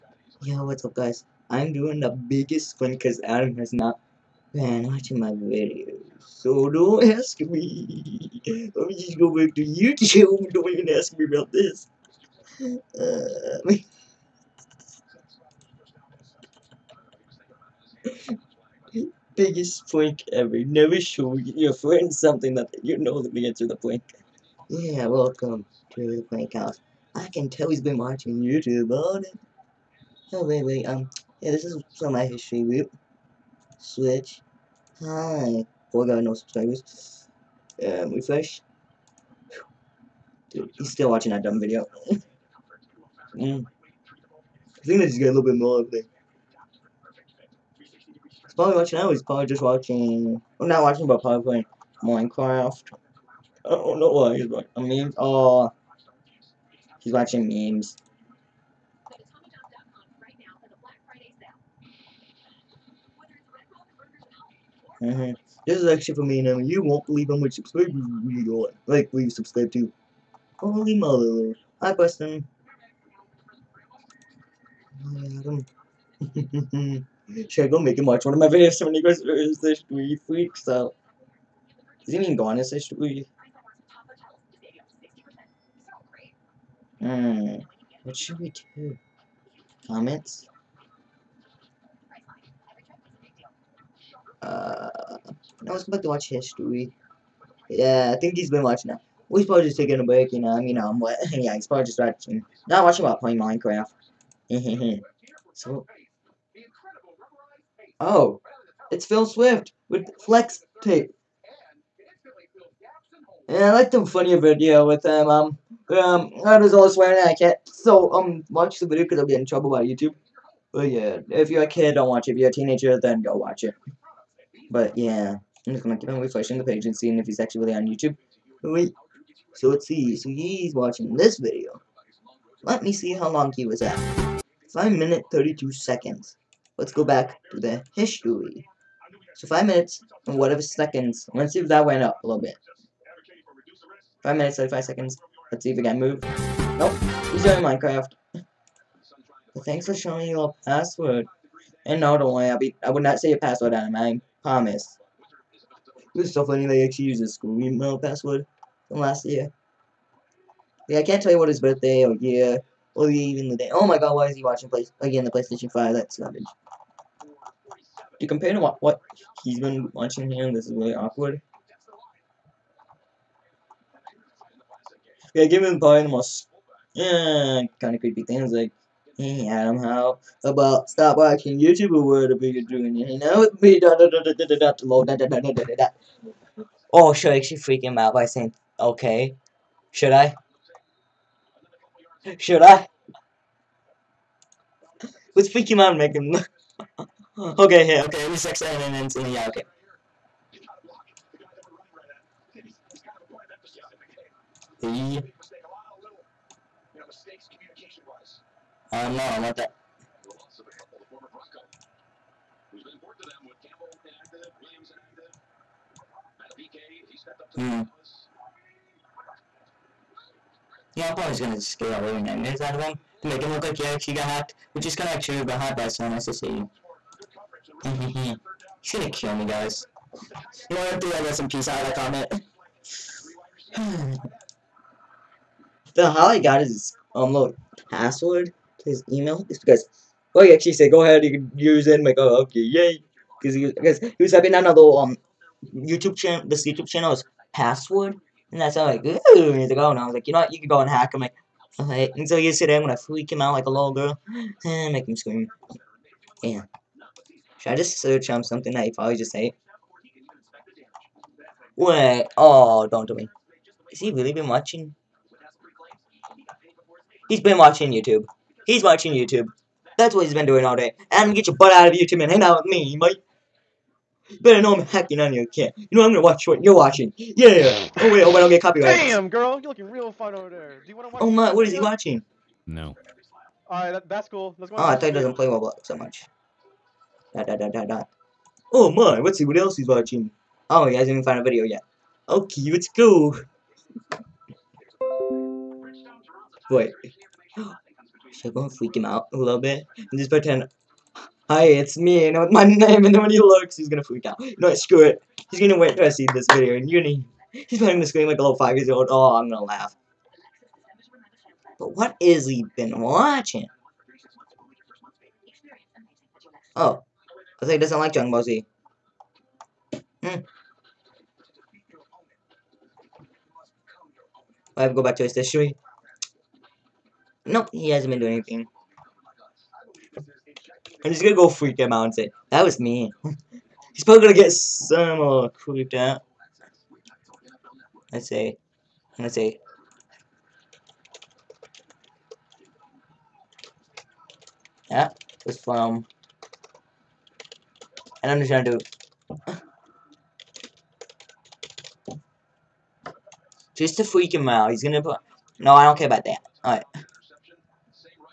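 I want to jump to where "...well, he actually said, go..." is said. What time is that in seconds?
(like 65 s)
240 s.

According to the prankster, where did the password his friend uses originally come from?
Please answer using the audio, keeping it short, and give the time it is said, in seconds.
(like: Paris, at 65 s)
school email, at 157 s.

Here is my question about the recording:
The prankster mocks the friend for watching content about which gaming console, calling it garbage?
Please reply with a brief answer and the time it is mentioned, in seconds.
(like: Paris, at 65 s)
PlayStation 5, at 165 s.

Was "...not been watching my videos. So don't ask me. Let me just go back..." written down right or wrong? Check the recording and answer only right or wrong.
right.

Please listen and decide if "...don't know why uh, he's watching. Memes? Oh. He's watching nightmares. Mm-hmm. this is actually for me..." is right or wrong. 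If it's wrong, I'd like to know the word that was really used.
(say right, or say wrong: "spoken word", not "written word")
wrong: "memes", not "nightmares".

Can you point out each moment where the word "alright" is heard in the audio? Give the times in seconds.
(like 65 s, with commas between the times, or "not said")
251 s, 283 s, 356 s.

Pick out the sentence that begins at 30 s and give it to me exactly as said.
Oh, wait, wait, um, yeah, this is from my history group.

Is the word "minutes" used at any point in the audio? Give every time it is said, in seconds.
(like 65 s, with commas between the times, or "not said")
134 s, 139 s, 144 s.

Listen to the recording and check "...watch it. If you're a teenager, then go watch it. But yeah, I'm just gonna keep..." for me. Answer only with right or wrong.
right.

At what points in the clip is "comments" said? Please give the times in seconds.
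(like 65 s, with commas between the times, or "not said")
89 s, 231 s.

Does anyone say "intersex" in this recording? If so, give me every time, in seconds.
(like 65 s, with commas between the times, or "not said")
198 s.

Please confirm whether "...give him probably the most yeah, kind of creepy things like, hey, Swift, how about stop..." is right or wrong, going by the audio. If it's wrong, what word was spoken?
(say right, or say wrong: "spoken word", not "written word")
wrong: "Adam", not "Swift".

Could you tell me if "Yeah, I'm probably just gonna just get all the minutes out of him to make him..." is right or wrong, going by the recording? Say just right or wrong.
wrong.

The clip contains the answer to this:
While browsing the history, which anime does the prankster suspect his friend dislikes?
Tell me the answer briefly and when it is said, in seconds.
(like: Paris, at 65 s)
Dragon Ball Z, at 318 s.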